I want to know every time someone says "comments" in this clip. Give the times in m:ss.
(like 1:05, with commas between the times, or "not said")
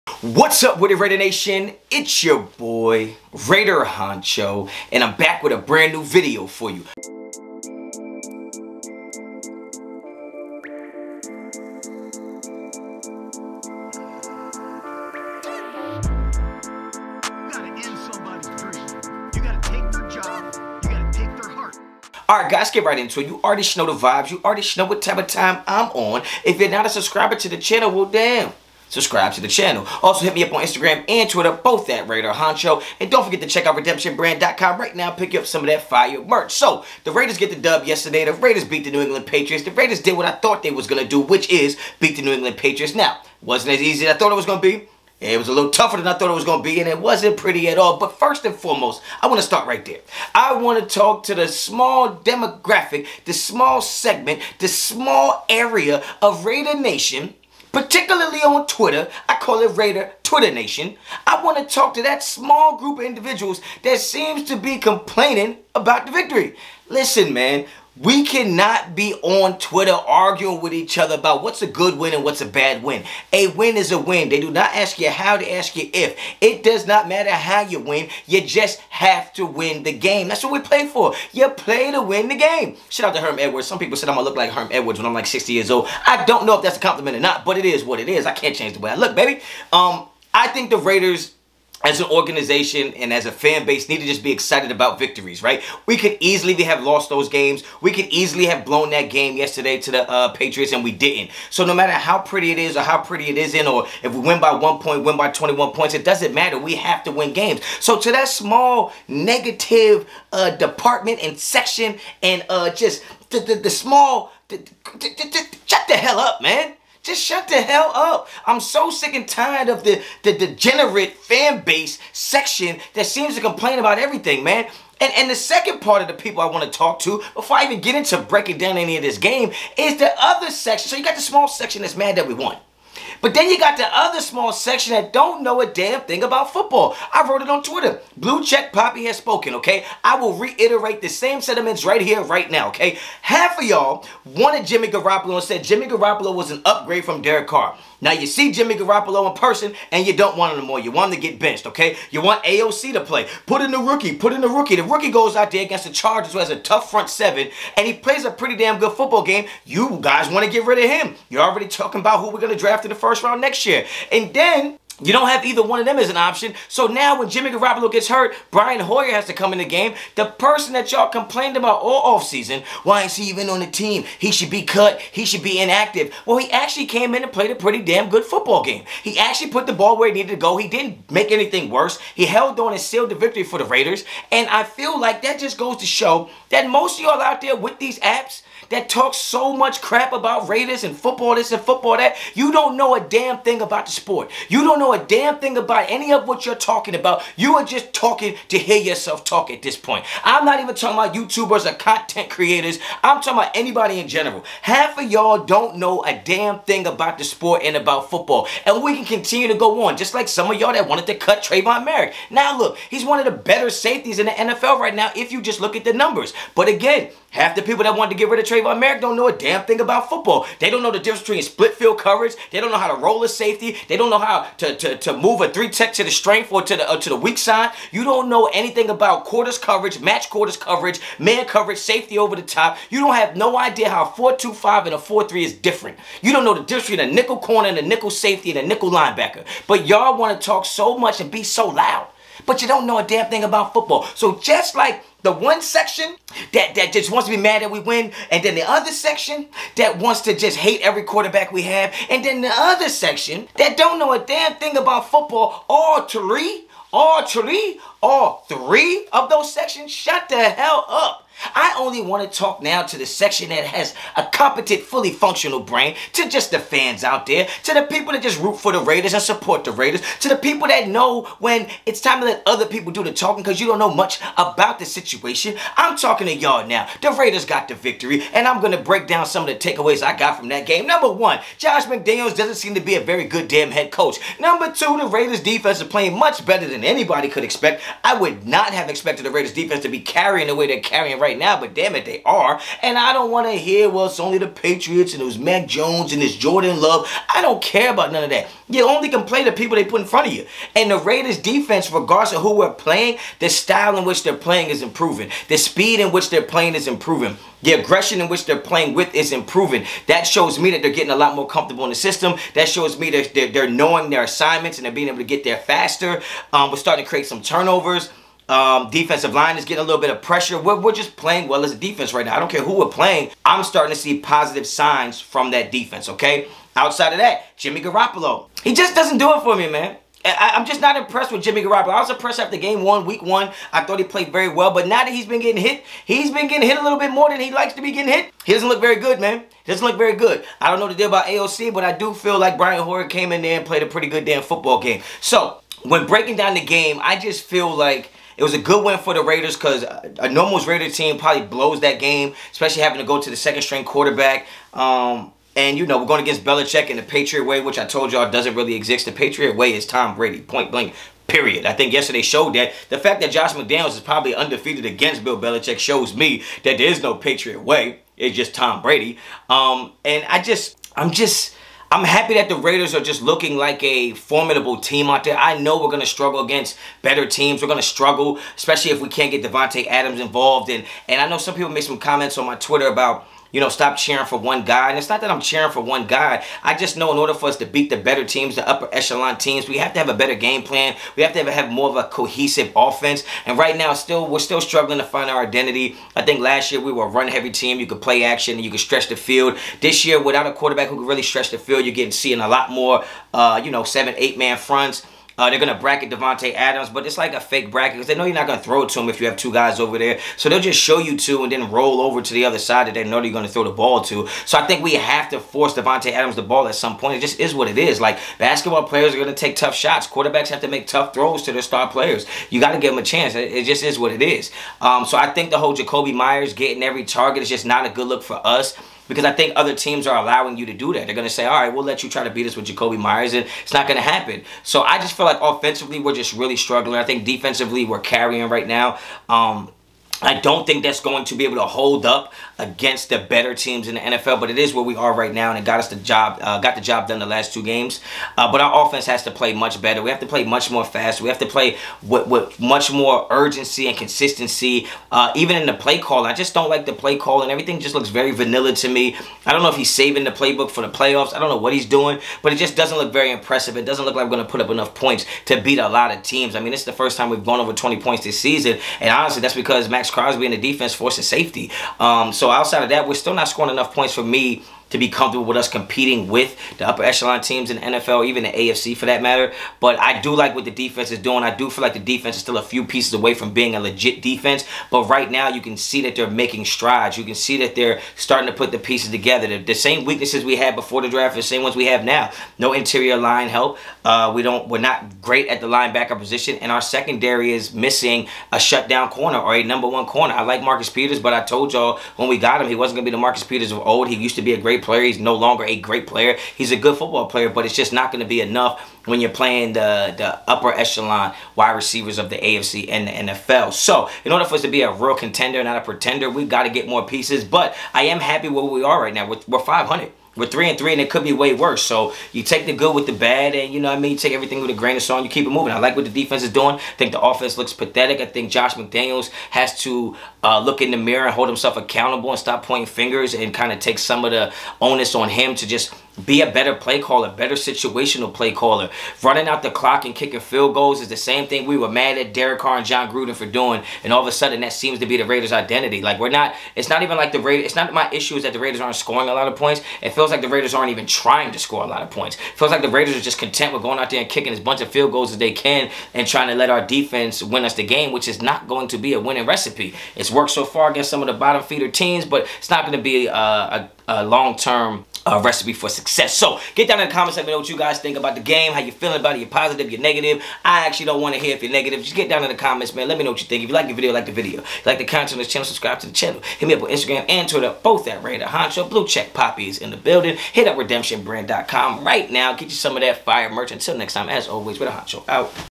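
6:21, 9:27, 9:32.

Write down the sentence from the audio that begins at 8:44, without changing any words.
You take everything with a grain of salt.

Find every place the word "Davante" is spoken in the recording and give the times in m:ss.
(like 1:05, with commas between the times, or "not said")
6:19, 6:46, 6:55.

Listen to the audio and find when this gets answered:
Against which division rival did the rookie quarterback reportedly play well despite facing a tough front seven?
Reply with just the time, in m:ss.
2:35.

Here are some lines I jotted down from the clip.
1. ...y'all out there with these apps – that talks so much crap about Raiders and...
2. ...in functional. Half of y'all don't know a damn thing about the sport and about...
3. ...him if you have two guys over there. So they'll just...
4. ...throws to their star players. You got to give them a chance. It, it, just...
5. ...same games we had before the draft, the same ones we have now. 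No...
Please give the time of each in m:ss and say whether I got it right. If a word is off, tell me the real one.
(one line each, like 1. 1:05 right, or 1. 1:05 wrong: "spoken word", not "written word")
1. 3:07 right
2. 3:23 wrong: "general", not "functional"
3. 6:48 right
4. 7:01 right
5. 8:09 wrong: "weaknesses", not "games".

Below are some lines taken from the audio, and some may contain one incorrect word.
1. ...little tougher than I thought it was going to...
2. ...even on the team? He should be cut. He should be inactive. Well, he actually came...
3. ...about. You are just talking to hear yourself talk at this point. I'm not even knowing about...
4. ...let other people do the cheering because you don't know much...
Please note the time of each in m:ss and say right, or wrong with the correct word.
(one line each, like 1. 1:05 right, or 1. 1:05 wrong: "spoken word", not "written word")
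1. 0:45 right
2. 2:53 right
3. 3:16 wrong: "talking", not "knowing"
4. 4:32 wrong: "talking", not "cheering".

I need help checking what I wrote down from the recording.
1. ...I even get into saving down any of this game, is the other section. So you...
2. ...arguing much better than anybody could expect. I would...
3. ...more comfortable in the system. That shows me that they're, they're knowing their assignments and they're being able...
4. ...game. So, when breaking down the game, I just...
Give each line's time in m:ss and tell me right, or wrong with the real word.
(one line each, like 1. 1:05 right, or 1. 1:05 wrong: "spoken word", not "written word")
1. 2:07 wrong: "breaking", not "saving"
2. 4:45 wrong: "playing", not "arguing"
3. 5:11 right
4. 5:44 right.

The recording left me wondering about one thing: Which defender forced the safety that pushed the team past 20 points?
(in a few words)
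Maxx Crosby.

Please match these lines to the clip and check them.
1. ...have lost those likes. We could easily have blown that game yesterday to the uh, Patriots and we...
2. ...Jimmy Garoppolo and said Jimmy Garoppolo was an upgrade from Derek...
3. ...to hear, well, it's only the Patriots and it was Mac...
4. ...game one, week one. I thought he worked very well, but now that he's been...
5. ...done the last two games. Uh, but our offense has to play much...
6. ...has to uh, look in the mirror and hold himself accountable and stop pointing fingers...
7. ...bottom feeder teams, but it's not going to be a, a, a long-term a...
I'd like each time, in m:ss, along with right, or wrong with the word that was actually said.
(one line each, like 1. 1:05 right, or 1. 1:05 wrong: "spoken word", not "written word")
1. 1:36 wrong: "games", not "likes"
2. 2:24 right
3. 4:53 right
4. 5:32 wrong: "played", not "worked"
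5. 7:27 right
6. 8:49 right
7. 9:21 right.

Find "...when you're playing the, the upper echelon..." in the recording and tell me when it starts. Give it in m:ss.
8:29.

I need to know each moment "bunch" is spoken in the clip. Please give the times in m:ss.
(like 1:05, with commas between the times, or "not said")
9:14.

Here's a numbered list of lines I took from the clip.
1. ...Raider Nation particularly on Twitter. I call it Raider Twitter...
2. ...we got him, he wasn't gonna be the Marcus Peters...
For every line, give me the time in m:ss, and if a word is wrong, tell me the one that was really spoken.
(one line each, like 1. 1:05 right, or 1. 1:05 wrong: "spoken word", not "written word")
1. 0:56 right
2. 8:22 right.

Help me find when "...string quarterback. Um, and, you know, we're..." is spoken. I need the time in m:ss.
5:53.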